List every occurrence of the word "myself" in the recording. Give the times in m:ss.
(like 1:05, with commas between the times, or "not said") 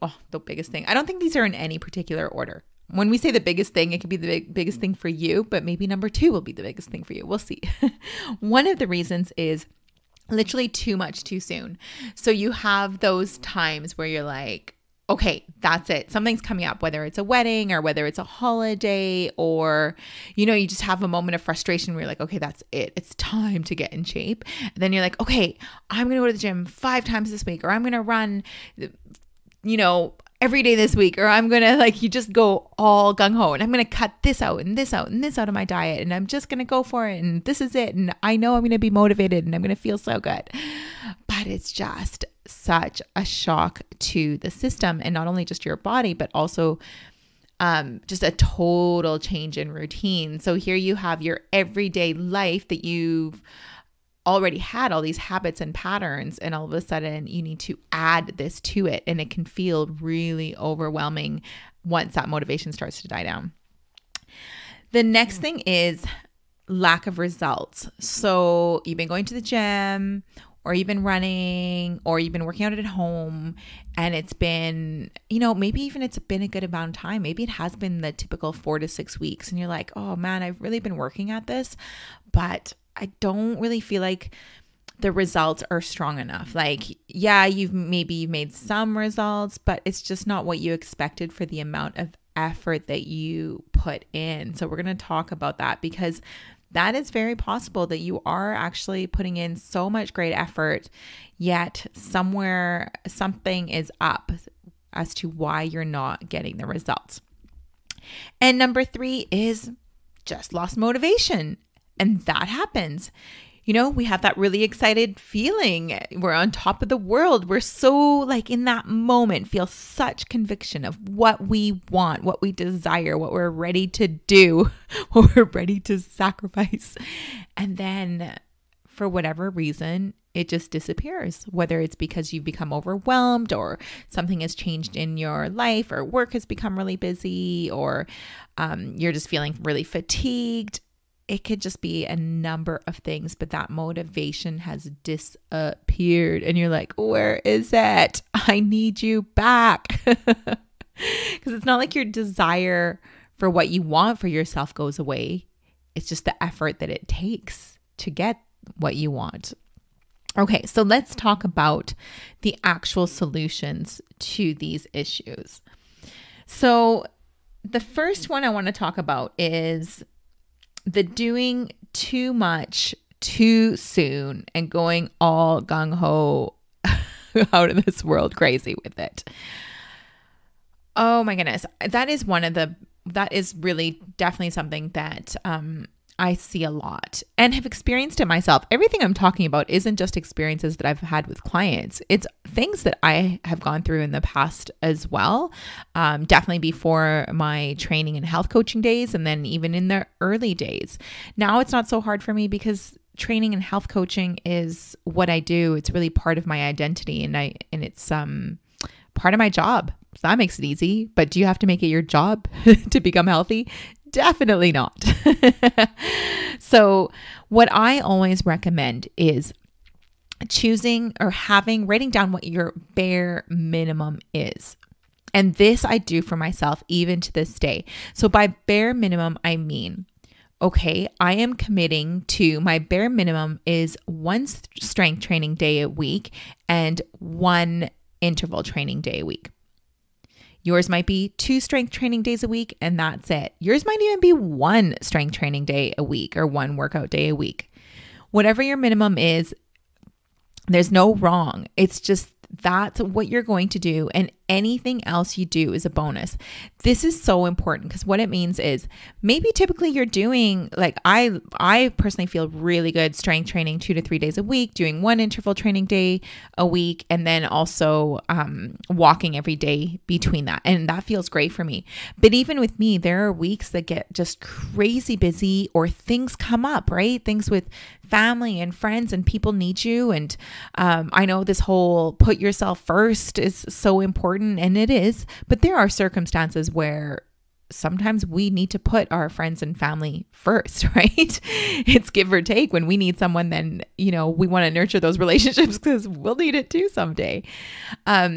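3:08, 3:46.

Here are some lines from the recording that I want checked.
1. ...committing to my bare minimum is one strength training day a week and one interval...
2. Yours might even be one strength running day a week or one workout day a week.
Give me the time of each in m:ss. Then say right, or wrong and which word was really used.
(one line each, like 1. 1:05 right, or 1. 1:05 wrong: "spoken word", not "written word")
1. 3:51 right
2. 4:03 wrong: "training", not "running".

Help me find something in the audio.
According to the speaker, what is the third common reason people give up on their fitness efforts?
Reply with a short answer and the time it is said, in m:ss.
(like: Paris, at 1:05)
Lost motivation, at 1:50.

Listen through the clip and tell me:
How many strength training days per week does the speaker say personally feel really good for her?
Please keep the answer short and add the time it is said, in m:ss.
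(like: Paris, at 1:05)
2 to 3, at 4:23.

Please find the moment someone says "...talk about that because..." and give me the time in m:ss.
1:35.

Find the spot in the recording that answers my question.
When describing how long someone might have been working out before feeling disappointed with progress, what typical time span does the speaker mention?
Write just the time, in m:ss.
1:18.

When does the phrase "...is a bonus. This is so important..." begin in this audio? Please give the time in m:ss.
4:15.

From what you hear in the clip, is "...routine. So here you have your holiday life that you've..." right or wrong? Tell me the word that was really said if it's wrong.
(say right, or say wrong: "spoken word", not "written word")
wrong: "everyday", not "holiday".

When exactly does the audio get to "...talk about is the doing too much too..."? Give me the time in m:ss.
2:48.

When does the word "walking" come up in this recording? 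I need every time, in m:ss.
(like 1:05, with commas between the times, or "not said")
4:28.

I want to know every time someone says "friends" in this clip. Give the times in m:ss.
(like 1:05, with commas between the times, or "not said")
4:38, 4:49.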